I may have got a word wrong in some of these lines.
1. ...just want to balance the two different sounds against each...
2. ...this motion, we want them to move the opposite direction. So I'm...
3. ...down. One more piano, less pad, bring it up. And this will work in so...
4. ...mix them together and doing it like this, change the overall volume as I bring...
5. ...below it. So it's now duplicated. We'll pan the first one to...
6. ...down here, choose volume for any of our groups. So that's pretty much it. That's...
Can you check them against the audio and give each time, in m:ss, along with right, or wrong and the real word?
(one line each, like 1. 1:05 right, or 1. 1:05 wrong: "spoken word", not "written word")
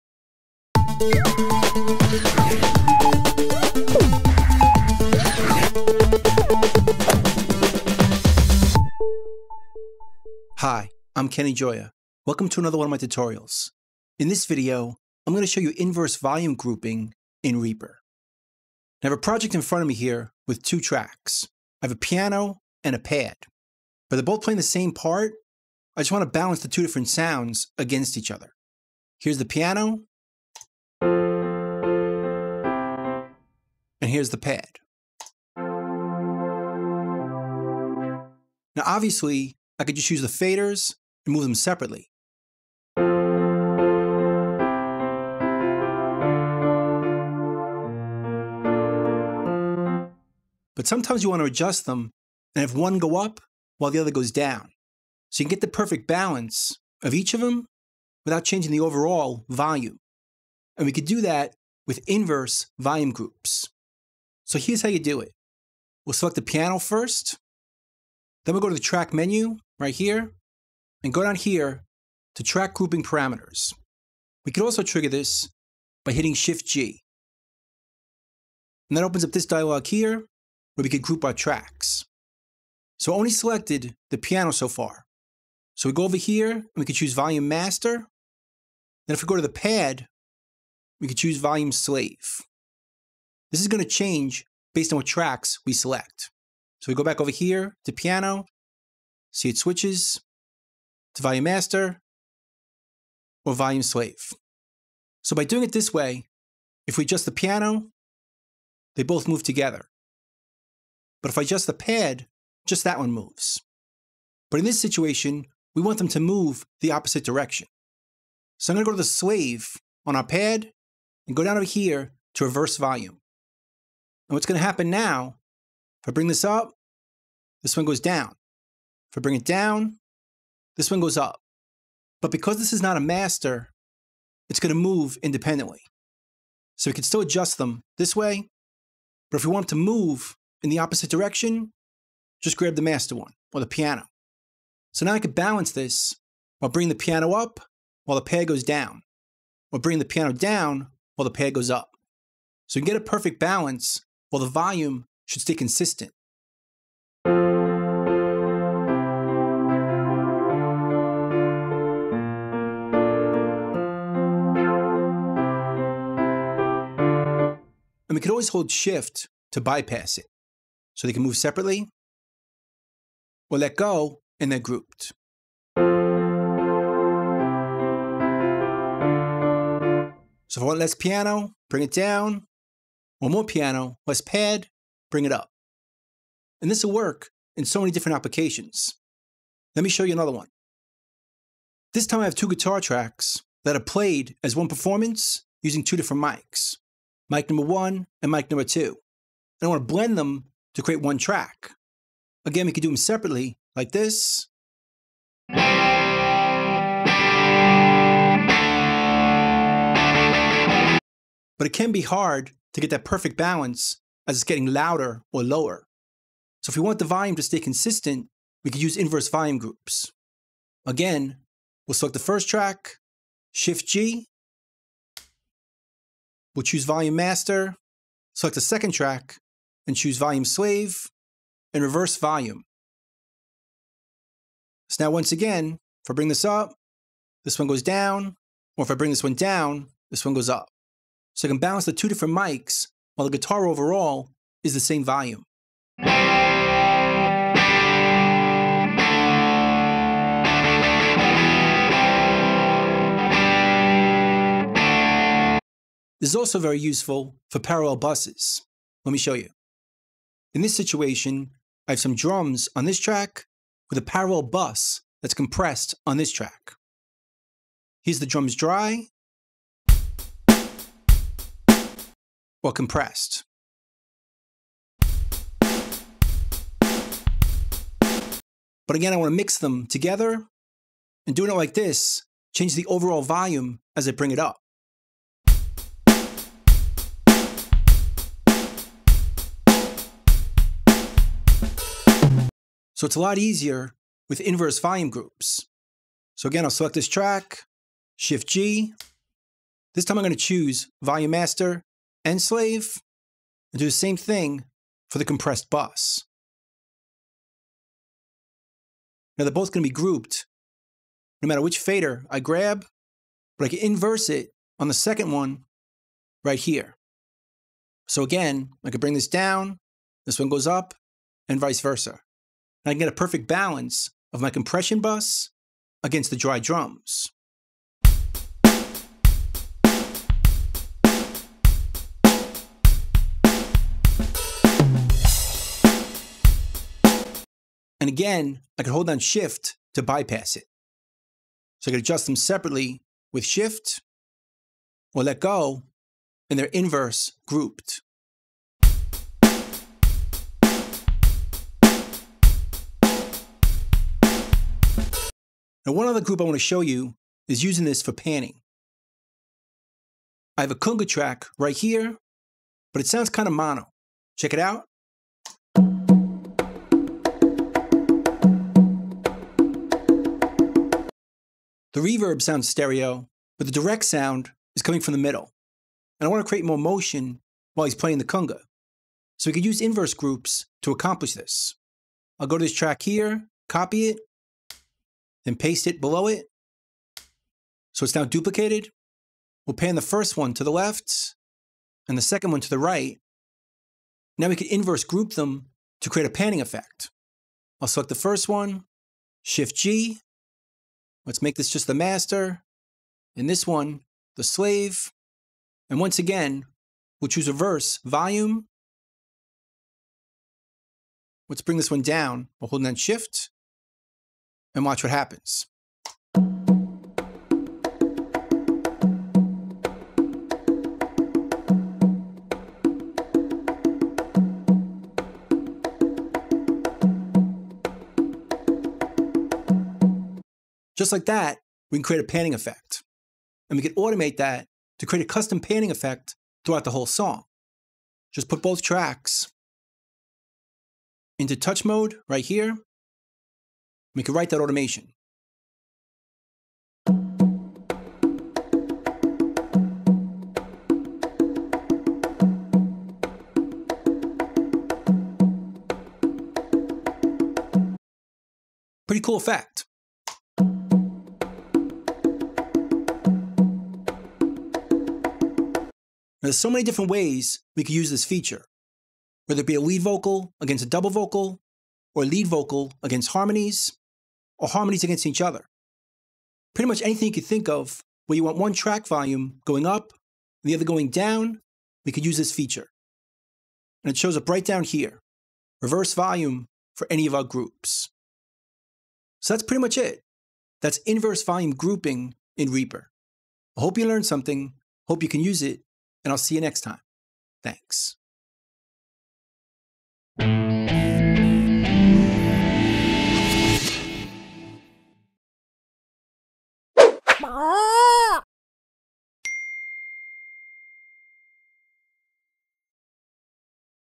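1. 0:26 right
2. 1:54 wrong: "situation", not "motion"
3. 3:01 right
4. 4:39 right
5. 6:25 right
6. 8:04 wrong: "reverse", not "choose".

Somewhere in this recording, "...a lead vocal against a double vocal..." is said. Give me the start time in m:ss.
7:49.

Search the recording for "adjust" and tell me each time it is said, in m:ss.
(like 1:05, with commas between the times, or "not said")
0:51, 1:47, 1:51, 2:17, 5:41.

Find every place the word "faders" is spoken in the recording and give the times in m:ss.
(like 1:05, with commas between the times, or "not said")
0:40, 5:11.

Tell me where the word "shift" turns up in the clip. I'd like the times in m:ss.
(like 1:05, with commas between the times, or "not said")
1:16, 2:48, 3:43, 4:58, 5:39, 5:43, 6:39, 6:52.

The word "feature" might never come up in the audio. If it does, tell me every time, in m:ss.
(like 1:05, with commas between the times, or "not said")
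7:48, 8:02.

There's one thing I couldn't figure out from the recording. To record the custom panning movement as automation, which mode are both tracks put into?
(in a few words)
Touch mode.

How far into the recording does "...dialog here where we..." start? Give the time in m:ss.
1:19.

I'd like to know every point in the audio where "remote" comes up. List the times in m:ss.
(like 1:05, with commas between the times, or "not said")
not said.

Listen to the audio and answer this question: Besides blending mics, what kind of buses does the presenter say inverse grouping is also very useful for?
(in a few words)
Parallel buses.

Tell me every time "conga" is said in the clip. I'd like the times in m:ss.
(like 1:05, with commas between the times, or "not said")
6:00, 6:18.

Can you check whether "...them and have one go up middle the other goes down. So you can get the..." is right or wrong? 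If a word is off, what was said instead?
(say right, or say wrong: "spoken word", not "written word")
wrong: "while", not "middle".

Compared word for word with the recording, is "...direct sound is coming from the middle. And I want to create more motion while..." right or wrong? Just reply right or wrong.
right.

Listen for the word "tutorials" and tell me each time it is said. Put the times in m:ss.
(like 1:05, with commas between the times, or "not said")
0:12.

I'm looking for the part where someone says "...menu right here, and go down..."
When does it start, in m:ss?
1:09.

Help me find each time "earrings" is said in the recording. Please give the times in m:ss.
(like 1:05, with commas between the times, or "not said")
not said.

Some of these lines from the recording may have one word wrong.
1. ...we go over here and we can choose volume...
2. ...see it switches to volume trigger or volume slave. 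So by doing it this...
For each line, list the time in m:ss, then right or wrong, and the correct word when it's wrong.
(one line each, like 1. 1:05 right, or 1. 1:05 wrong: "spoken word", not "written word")
1. 1:25 right
2. 1:39 wrong: "master", not "trigger".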